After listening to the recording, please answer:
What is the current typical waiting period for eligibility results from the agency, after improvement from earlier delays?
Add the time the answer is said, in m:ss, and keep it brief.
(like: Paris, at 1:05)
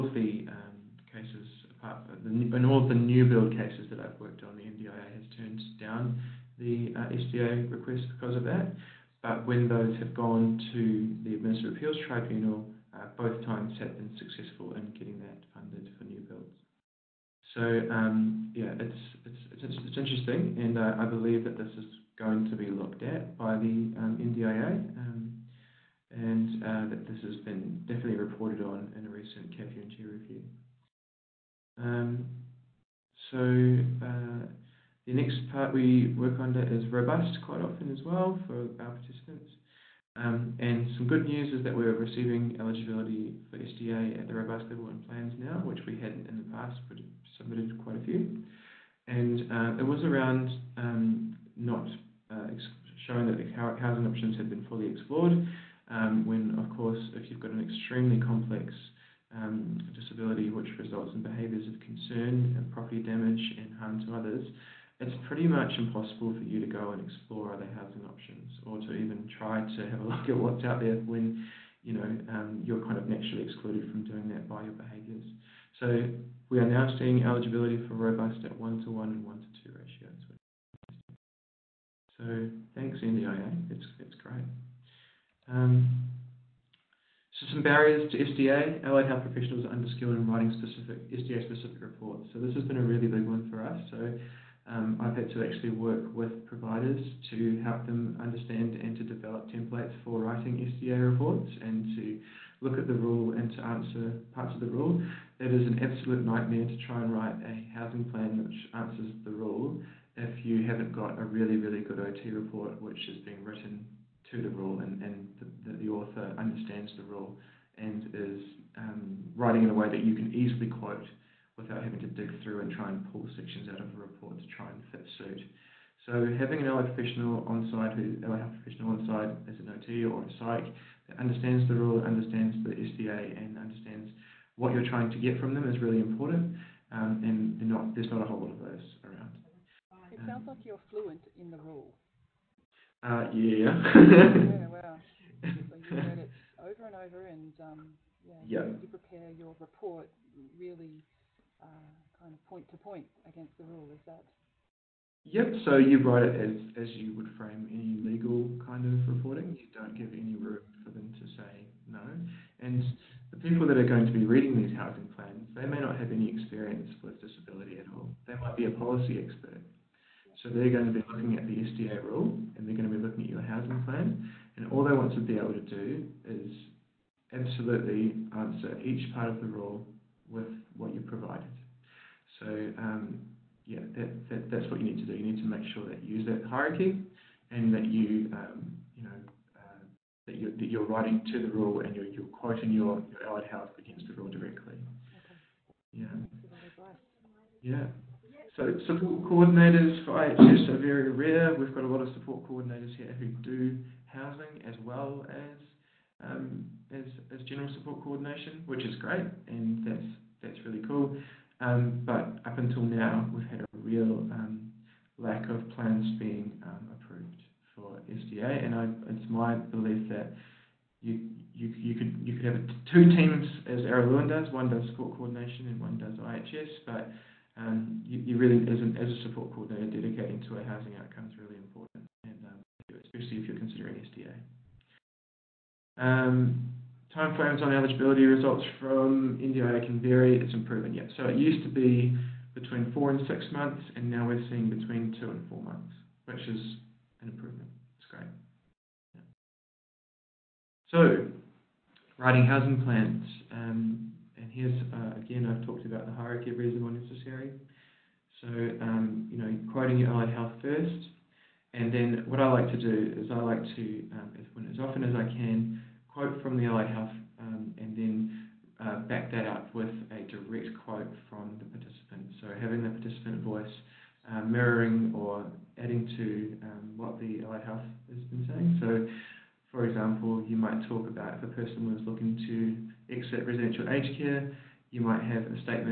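2 to 4 months, at 4:05.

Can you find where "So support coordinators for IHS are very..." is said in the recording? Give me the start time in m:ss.
3:18.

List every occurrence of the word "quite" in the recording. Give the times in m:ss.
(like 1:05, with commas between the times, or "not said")
0:37, 0:47.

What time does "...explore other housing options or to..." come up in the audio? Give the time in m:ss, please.
1:07.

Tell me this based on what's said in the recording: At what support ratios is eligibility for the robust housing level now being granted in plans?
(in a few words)
1 to 1 and 1 to 2.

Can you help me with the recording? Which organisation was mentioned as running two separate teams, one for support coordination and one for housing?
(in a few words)
Araluen.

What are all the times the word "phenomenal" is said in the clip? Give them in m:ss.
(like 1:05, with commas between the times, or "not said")
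not said.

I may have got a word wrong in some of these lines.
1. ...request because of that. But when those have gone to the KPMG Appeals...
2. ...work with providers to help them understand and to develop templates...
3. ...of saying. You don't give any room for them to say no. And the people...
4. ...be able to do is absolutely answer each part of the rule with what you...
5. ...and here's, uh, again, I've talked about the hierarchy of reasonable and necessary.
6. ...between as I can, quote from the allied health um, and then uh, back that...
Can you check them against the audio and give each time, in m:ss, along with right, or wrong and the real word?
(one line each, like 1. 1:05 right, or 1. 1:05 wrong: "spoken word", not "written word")
1. 0:07 wrong: "Administrative", not "KPMG"
2. 1:35 right
3. 2:38 wrong: "reporting", not "saying"
4. 2:55 right
5. 4:14 right
6. 4:24 wrong: "often", not "between".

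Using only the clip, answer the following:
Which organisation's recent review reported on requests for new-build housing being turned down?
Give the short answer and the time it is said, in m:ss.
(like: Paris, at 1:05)
KPMG, at 0:29.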